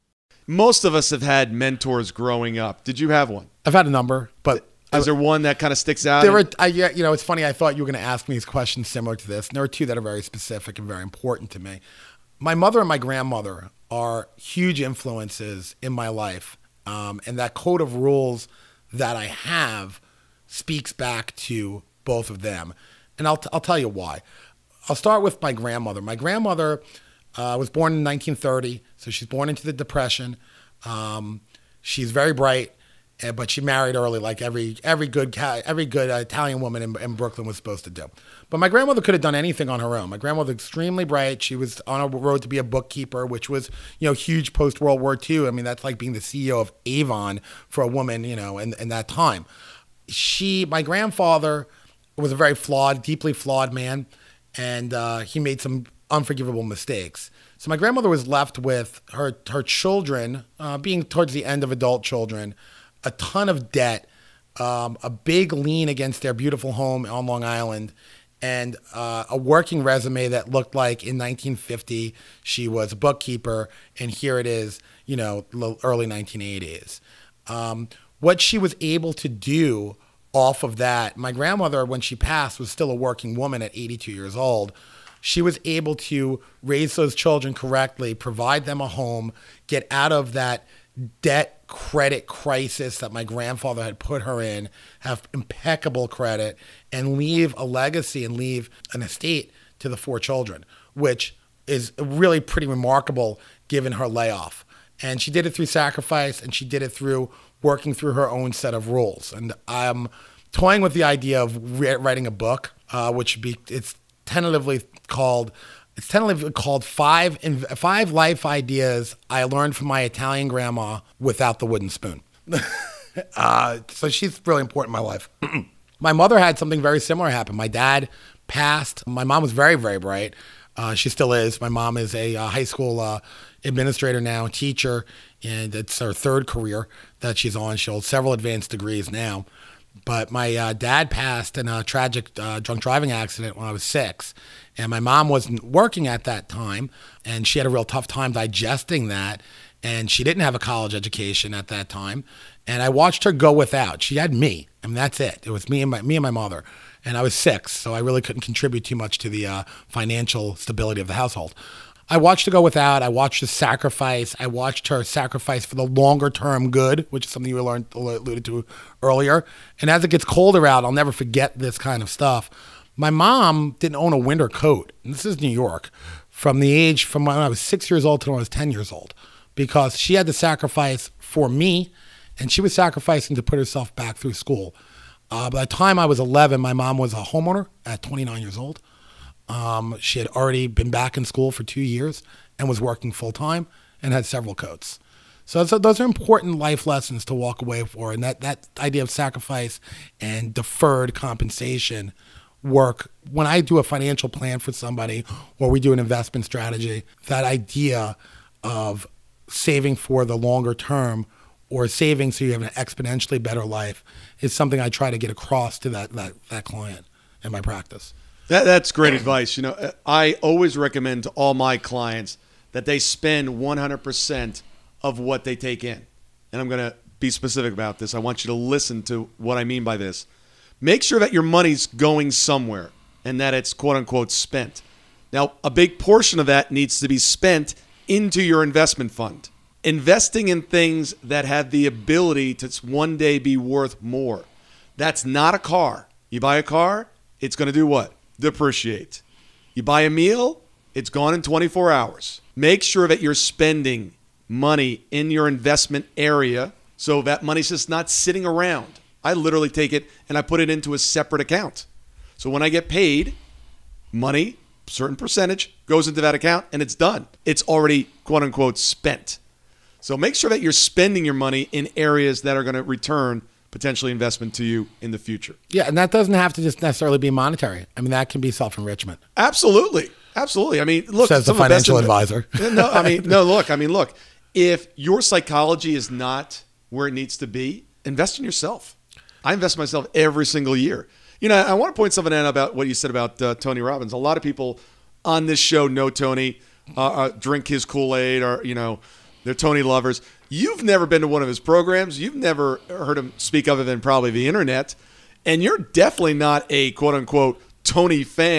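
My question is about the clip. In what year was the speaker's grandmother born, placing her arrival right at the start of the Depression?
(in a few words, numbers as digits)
1930.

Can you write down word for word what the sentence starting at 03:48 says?
I want you to listen to what I mean by this.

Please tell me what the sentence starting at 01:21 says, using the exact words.
My grandmother, when she passed, was still a working woman at 82 years old.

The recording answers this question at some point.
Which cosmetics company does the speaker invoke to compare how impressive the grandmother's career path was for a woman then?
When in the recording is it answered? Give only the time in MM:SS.
00:46.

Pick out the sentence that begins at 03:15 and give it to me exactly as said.
So, so, those are important life lessons to walk away for, and that that idea of sacrifice and deferred compensation work.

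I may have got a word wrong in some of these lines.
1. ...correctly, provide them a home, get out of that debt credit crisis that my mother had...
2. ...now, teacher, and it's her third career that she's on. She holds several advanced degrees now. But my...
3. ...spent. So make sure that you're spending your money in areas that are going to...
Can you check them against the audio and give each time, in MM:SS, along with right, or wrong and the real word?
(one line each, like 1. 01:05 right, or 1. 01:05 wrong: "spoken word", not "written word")
1. 01:27 wrong: "grandfather", not "mother"
2. 02:14 right
3. 04:28 right.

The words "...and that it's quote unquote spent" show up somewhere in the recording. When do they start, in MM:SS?
03:53.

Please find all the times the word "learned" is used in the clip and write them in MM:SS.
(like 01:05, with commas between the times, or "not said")
01:59, 02:47.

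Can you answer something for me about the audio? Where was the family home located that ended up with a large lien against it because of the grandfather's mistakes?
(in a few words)
Long Island.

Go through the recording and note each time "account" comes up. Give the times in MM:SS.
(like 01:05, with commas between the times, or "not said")
04:21, 04:26.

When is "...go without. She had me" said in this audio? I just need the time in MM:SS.
02:33.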